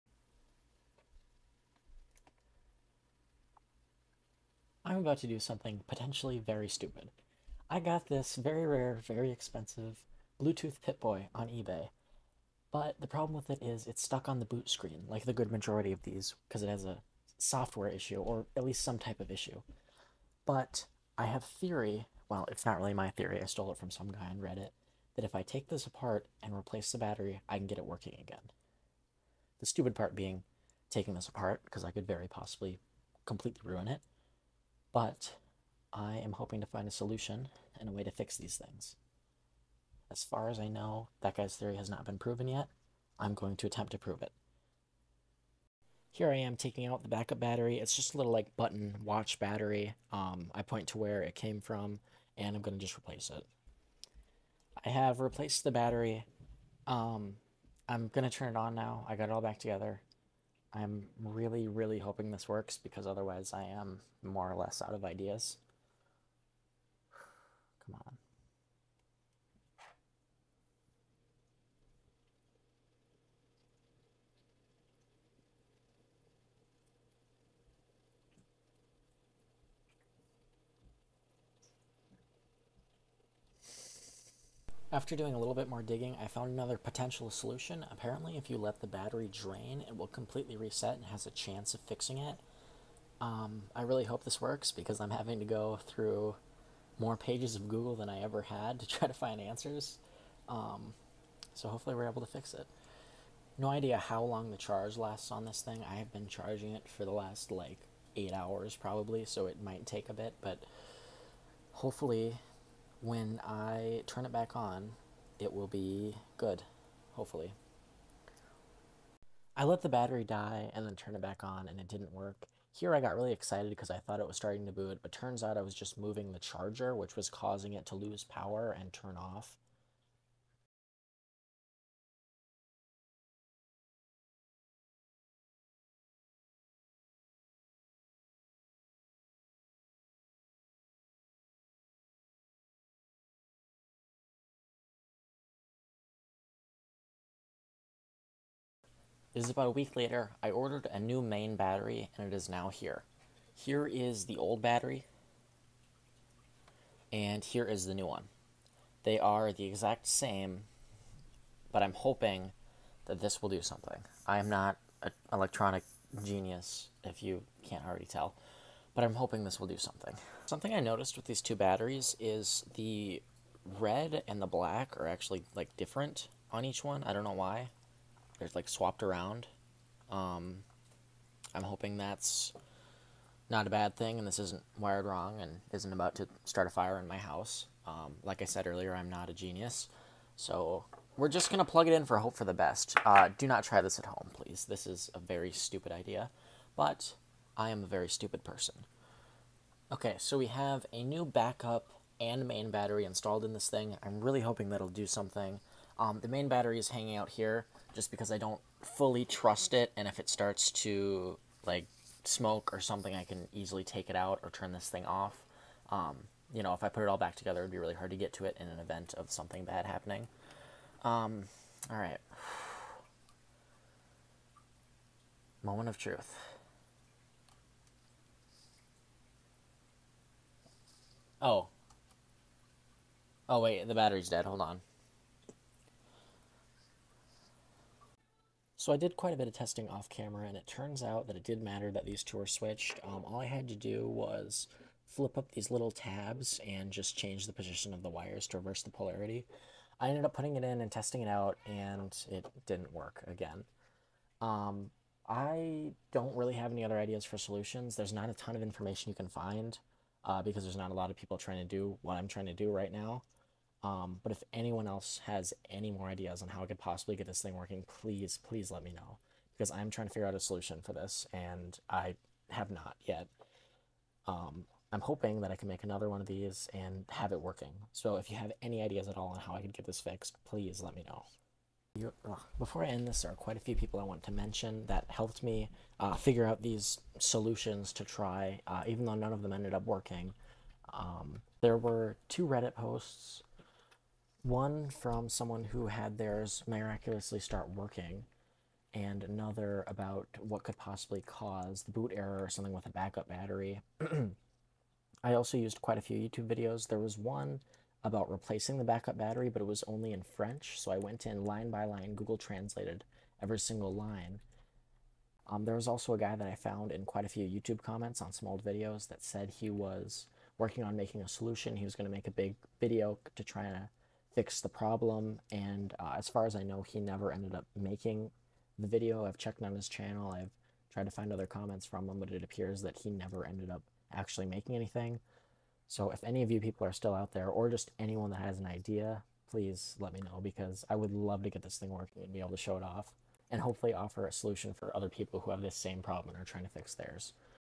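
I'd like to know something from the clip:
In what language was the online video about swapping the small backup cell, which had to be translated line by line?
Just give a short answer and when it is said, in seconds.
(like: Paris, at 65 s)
French, at 310 s.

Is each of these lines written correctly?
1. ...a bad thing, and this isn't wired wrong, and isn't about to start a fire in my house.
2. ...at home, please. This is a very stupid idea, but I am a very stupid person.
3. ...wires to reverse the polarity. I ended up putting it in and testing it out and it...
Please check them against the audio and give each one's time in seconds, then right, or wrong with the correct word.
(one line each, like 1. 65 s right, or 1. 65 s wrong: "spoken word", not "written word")
1. 183 s right
2. 193 s right
3. 248 s right.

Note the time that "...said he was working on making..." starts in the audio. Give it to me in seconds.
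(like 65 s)
319 s.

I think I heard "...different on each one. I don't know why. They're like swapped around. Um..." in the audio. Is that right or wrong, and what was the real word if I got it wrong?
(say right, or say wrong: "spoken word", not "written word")
right.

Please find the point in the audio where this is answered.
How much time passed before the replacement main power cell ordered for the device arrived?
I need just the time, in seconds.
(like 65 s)
149 s.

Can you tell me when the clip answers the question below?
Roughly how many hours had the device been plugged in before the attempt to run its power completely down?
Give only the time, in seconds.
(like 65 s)
108 s.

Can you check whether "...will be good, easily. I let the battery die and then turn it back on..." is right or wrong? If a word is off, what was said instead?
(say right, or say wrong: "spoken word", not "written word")
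wrong: "hopefully", not "easily".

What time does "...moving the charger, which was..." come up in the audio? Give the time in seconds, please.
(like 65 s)
125 s.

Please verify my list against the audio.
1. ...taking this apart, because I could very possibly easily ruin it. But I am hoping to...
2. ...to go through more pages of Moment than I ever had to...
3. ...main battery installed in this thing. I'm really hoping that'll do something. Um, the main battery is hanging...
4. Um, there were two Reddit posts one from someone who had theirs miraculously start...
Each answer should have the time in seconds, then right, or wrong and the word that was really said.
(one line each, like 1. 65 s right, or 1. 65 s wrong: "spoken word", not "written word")
1. 30 s wrong: "completely", not "easily"
2. 95 s wrong: "Google", not "Moment"
3. 202 s right
4. 290 s right.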